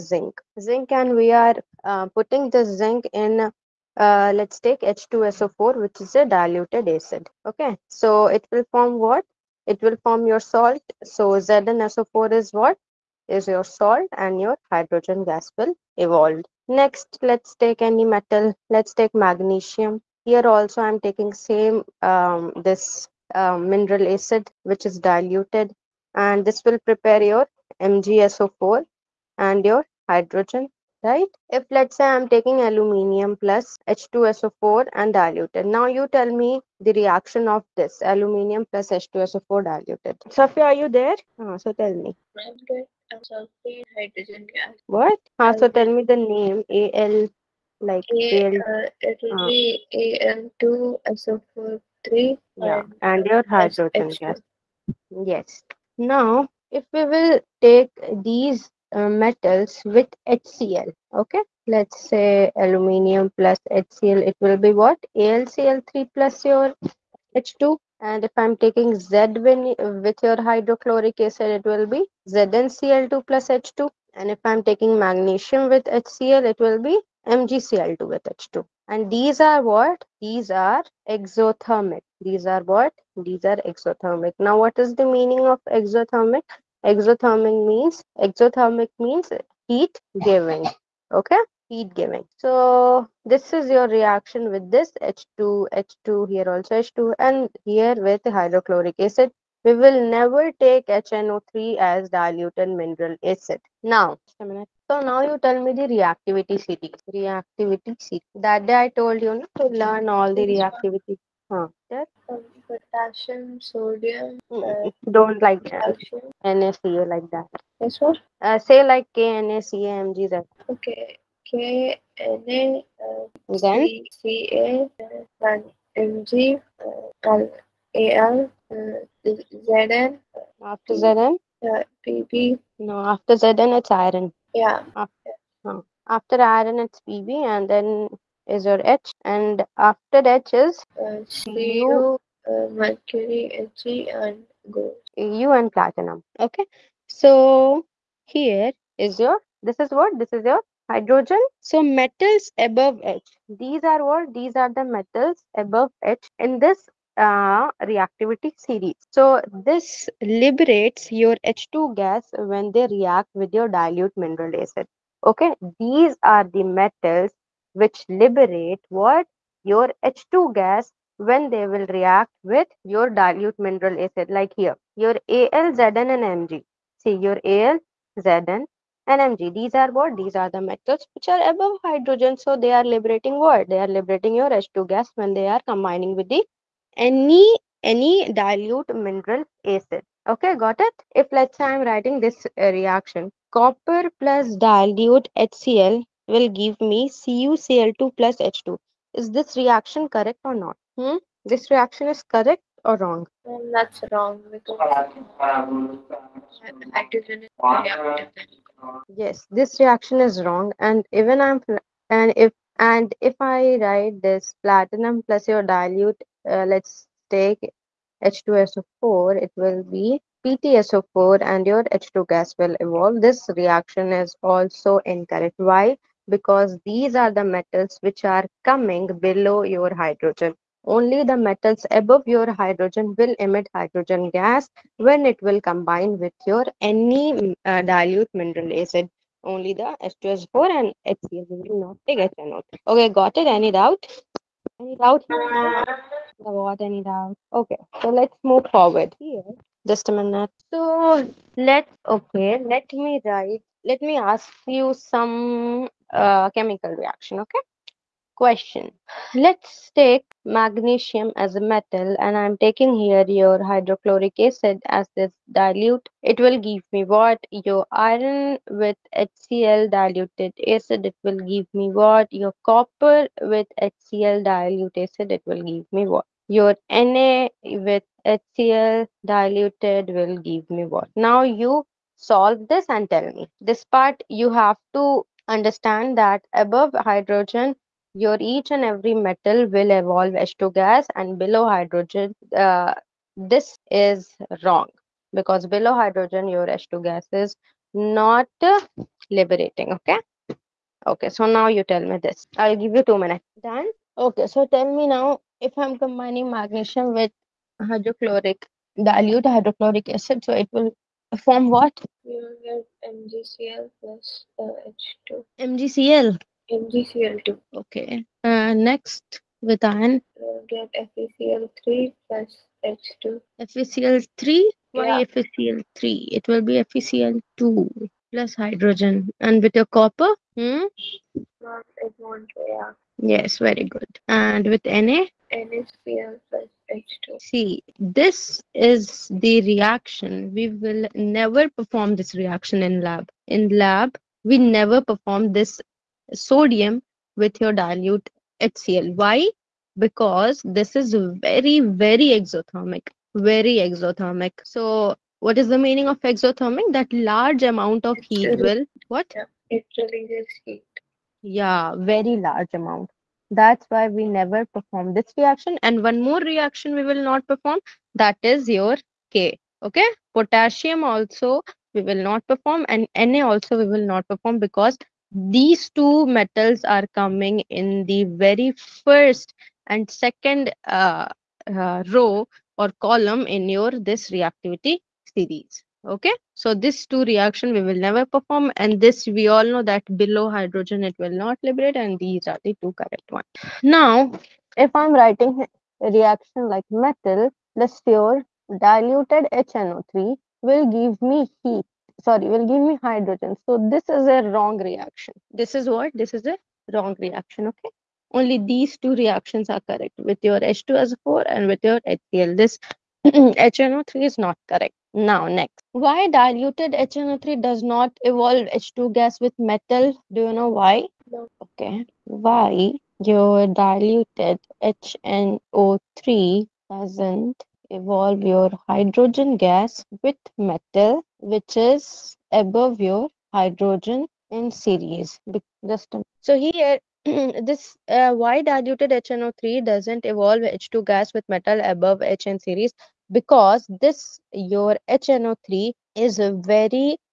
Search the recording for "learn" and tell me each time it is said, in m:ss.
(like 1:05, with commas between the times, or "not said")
1:49.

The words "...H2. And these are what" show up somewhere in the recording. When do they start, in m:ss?
1:18.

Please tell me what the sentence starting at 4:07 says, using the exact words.
Okay, so let's move forward here.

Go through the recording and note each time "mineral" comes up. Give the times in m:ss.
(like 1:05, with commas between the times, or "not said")
0:23, 1:42, 2:44, 2:53, 3:08, 3:58.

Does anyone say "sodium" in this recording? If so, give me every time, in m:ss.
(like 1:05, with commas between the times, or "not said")
1:53, 5:46.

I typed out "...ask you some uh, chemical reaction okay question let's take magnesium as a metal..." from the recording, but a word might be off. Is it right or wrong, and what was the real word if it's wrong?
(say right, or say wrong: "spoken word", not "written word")
right.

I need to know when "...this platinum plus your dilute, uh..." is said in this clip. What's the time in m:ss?
3:34.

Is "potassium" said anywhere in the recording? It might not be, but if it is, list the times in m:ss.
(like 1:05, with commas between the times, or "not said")
1:52, 6:10.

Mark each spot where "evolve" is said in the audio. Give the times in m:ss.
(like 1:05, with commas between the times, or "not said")
0:15, 3:42, 4:49, 6:58, 7:07, 7:20.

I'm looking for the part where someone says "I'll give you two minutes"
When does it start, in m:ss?
5:02.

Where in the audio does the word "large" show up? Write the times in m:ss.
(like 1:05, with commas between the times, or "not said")
5:57, 6:02.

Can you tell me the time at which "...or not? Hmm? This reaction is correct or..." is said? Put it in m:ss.
3:20.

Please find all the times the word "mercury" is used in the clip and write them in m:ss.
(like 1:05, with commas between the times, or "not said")
2:22.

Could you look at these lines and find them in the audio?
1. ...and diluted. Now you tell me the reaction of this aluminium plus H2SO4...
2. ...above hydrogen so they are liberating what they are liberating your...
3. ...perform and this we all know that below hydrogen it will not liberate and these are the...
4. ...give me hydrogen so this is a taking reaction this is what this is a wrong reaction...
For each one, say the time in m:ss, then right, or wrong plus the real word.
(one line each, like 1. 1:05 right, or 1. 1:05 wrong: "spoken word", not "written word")
1. 0:34 right
2. 3:01 right
3. 6:28 right
4. 6:42 wrong: "wrong", not "taking".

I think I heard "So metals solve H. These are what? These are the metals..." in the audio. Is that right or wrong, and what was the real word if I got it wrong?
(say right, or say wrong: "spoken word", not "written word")
wrong: "above", not "solve".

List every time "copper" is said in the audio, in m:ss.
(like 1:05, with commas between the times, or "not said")
3:13, 4:32, 5:29.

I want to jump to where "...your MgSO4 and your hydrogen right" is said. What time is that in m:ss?
0:27.